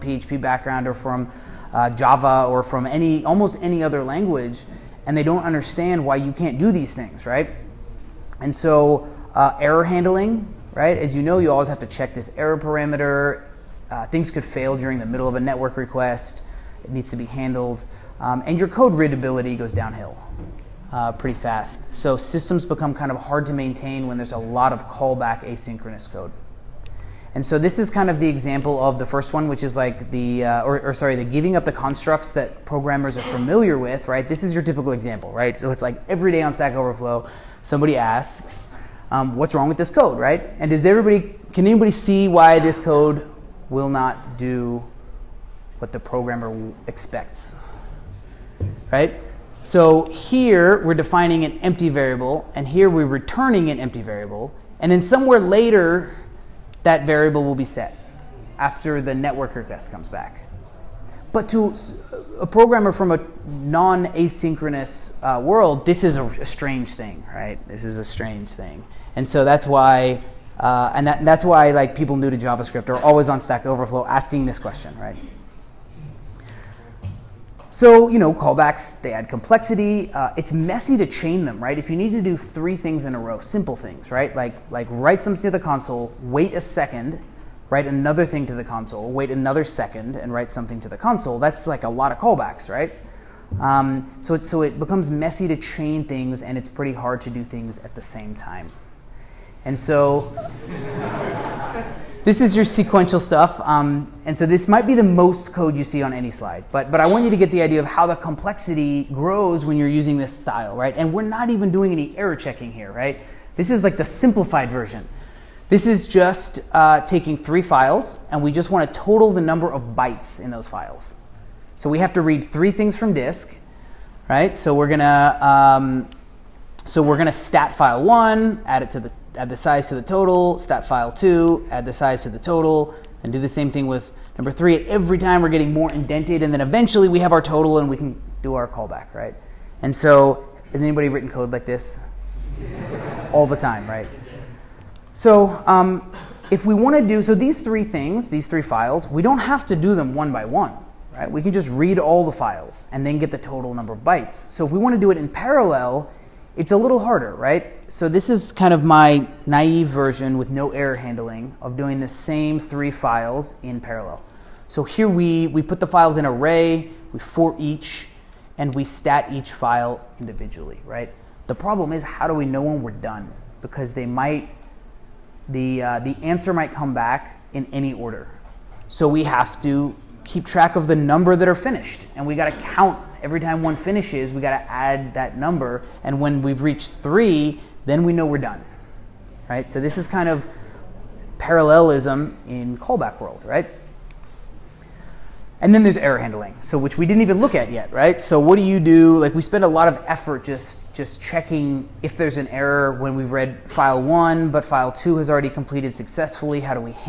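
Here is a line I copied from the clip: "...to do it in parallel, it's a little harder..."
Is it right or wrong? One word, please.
right.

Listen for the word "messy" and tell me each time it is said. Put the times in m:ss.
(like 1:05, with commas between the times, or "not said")
1:20, 1:35.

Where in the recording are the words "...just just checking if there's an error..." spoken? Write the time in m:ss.
3:20.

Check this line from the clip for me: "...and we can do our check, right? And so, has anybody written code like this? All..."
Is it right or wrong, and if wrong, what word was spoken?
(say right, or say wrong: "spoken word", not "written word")
wrong: "callback", not "check".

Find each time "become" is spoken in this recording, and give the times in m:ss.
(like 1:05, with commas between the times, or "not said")
0:22, 1:34.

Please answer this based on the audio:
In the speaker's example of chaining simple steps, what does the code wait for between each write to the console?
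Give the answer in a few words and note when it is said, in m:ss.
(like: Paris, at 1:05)
a second, at 1:26.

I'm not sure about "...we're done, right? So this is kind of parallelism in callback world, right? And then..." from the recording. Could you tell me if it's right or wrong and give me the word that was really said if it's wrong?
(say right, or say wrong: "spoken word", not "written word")
right.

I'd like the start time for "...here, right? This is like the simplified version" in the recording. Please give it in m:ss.
1:52.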